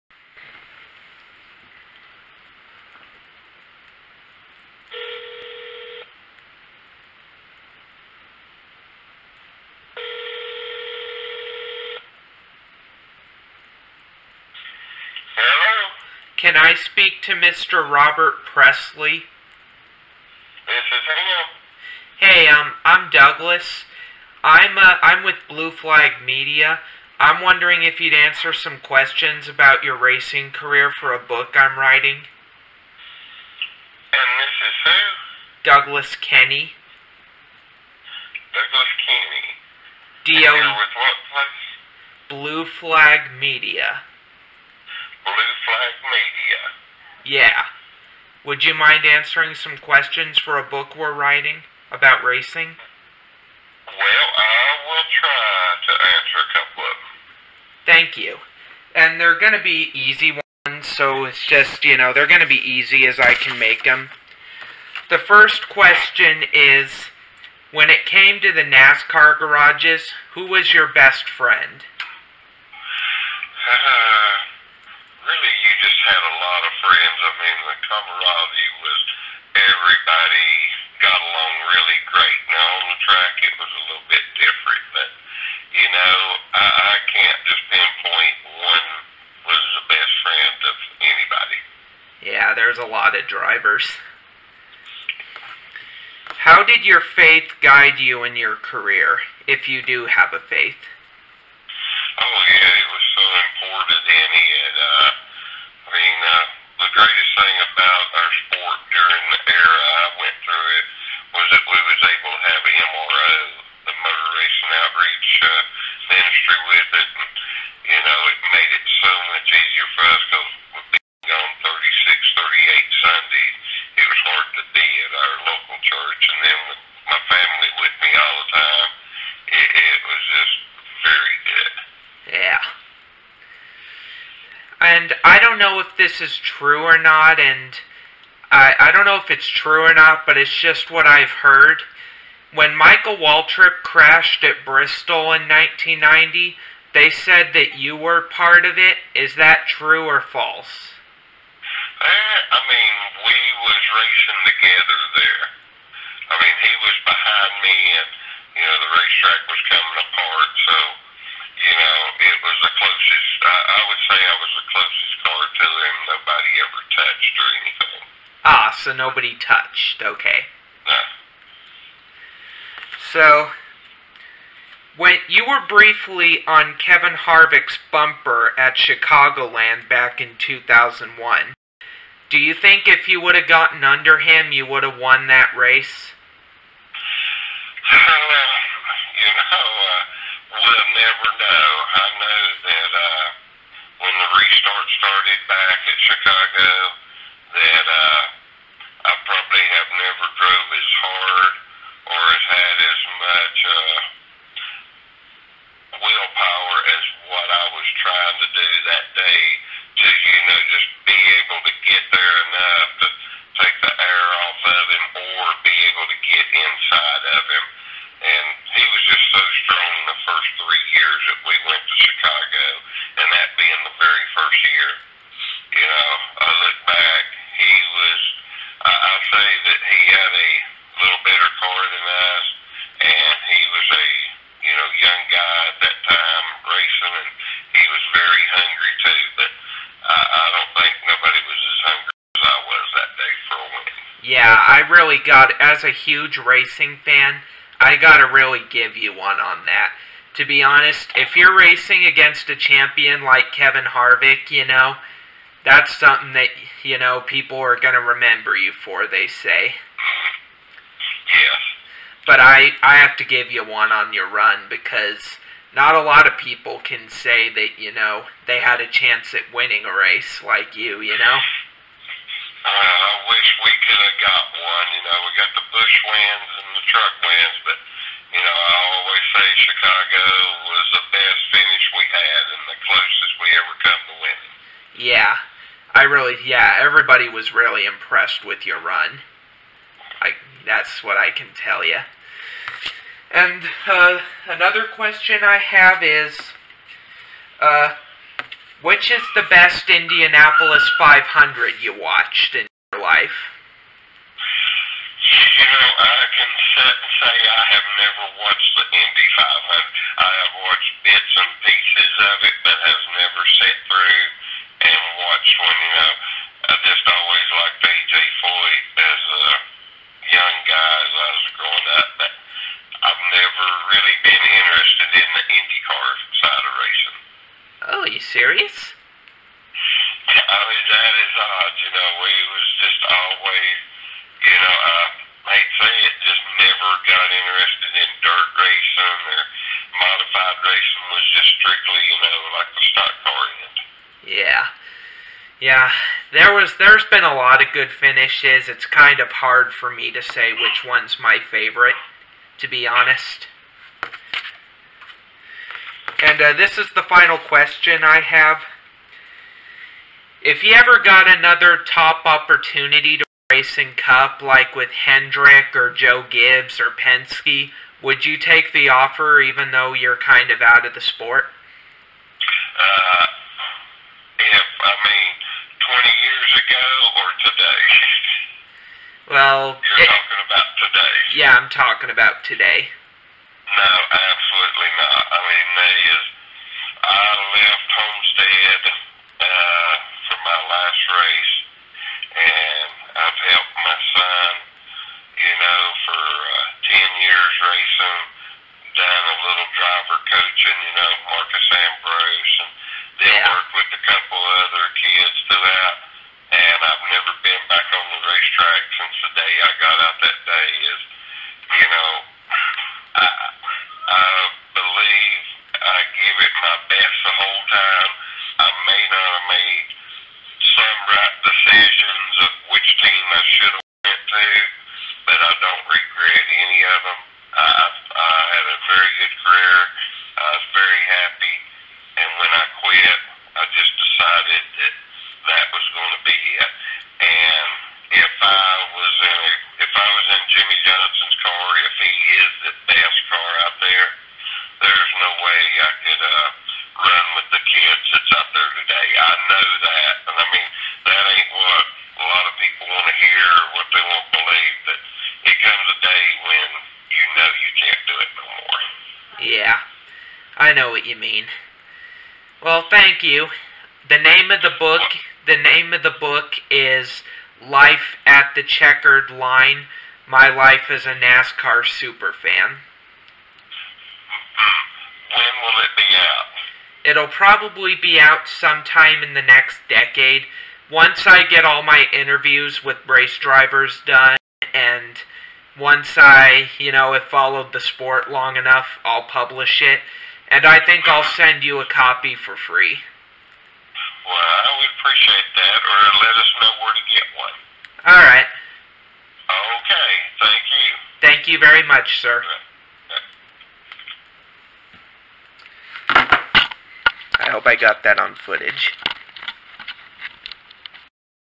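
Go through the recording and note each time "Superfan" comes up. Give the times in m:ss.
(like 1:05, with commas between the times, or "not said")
7:51.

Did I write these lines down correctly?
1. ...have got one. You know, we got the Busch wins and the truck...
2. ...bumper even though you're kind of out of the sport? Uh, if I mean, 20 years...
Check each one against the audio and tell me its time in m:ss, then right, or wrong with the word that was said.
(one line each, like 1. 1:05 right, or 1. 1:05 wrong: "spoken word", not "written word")
1. 4:34 right
2. 6:08 wrong: "offer", not "bumper".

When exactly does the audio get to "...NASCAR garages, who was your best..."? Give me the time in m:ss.
1:08.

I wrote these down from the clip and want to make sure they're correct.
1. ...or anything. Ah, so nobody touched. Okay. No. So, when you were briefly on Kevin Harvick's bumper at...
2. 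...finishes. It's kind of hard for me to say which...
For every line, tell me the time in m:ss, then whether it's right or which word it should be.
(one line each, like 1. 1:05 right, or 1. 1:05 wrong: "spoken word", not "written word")
1. 2:47 right
2. 5:47 right.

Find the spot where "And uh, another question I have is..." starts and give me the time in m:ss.
4:53.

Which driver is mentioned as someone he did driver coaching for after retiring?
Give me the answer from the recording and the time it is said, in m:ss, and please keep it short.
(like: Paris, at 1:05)
Marcos Ambrose, at 6:41.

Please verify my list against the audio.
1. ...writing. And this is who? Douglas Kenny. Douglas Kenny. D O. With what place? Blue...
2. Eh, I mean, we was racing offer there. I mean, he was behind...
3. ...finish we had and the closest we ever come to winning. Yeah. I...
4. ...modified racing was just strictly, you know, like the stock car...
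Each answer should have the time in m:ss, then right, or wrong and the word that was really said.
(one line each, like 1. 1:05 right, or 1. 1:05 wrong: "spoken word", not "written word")
1. 0:31 right
2. 2:32 wrong: "together", not "offer"
3. 4:41 right
4. 5:39 right.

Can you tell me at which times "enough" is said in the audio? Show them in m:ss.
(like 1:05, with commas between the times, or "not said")
3:32, 8:08.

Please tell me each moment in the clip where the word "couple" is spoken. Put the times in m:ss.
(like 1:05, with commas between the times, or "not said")
0:56, 6:44.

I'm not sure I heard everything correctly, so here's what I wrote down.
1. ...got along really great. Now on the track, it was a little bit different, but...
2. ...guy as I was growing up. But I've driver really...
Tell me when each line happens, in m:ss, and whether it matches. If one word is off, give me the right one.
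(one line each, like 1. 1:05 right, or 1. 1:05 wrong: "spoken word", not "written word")
1. 1:20 right
2. 5:20 wrong: "never", not "driver".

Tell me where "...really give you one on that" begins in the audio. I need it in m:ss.
4:08.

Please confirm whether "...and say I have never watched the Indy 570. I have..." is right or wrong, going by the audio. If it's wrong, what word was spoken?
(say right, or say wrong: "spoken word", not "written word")
wrong: "500", not "570".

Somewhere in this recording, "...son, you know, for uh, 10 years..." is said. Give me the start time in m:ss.
6:34.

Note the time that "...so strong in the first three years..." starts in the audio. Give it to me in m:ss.
3:39.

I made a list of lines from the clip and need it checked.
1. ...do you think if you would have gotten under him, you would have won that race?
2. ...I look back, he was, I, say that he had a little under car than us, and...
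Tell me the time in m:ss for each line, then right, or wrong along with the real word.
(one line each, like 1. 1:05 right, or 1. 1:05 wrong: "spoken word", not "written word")
1. 3:02 right
2. 3:46 wrong: "better", not "under".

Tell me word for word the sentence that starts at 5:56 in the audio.
And uh, this is the final question I have.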